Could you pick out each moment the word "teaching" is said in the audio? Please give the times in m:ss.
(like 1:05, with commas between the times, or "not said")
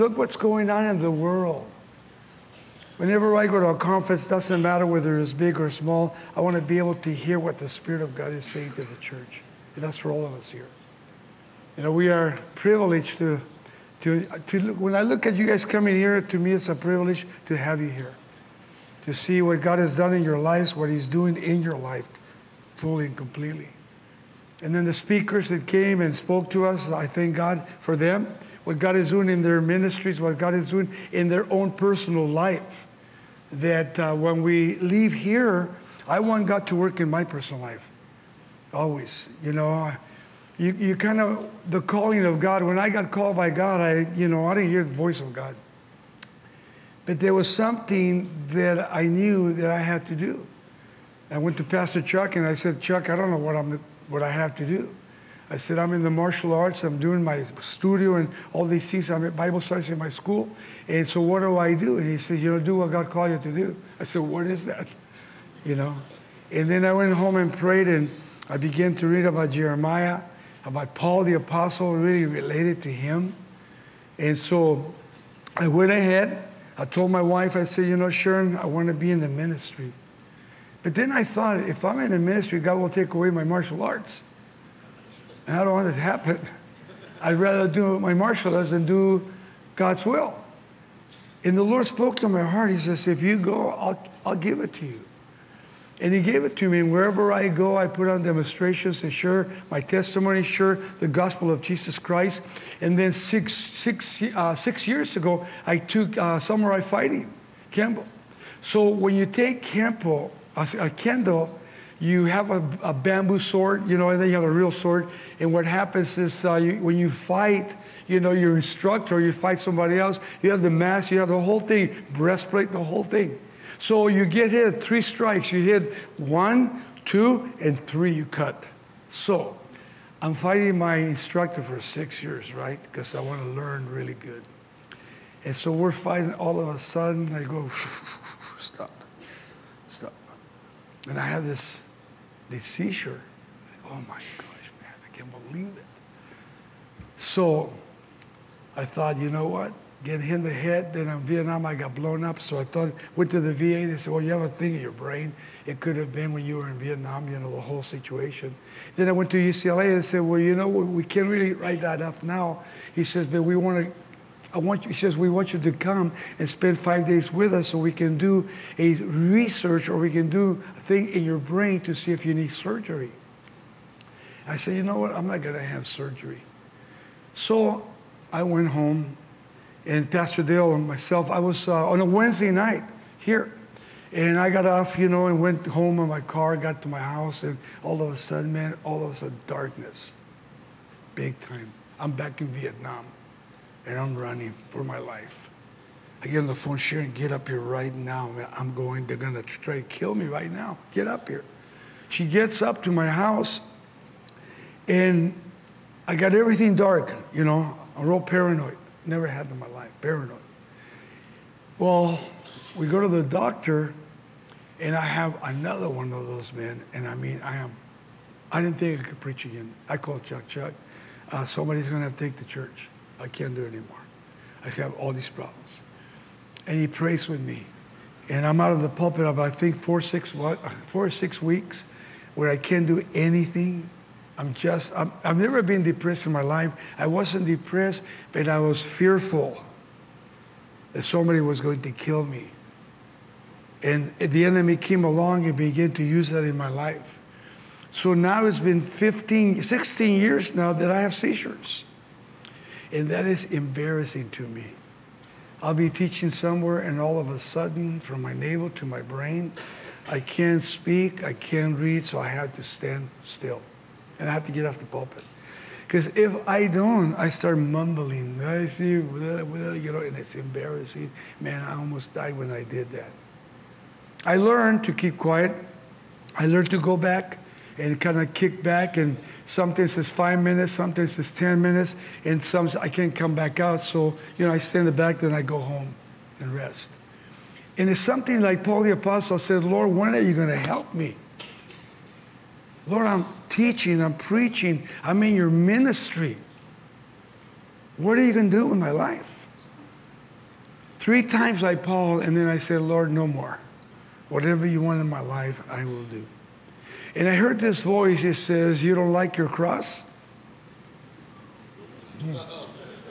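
4:15, 4:53.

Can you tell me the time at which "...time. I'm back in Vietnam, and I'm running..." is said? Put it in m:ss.
3:11.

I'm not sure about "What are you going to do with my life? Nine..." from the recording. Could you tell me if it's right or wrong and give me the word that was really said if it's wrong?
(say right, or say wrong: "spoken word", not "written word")
wrong: "Three", not "Nine".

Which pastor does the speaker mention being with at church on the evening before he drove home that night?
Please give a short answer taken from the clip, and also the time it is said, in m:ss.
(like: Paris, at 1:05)
Pastor Dale, at 3:00.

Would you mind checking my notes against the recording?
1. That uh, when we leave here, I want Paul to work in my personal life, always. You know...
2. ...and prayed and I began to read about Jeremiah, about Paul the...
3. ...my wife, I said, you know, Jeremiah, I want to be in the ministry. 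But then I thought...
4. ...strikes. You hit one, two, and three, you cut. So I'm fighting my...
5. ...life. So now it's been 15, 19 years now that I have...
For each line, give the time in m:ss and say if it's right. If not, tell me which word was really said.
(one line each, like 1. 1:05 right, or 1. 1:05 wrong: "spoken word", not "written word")
1. 0:33 wrong: "God", not "Paul"
2. 1:07 right
3. 1:17 wrong: "Sharon", not "Jeremiah"
4. 2:05 right
5. 4:06 wrong: "16", not "19".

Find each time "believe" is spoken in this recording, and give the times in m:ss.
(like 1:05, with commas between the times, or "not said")
2:25.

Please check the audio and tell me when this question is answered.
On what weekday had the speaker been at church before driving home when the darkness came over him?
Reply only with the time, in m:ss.
3:02.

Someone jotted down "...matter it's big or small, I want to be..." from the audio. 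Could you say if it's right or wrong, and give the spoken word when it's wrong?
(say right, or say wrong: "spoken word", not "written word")
wrong: "whether", not "matter".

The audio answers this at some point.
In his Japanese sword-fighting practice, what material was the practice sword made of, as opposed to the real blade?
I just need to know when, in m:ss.
1:52.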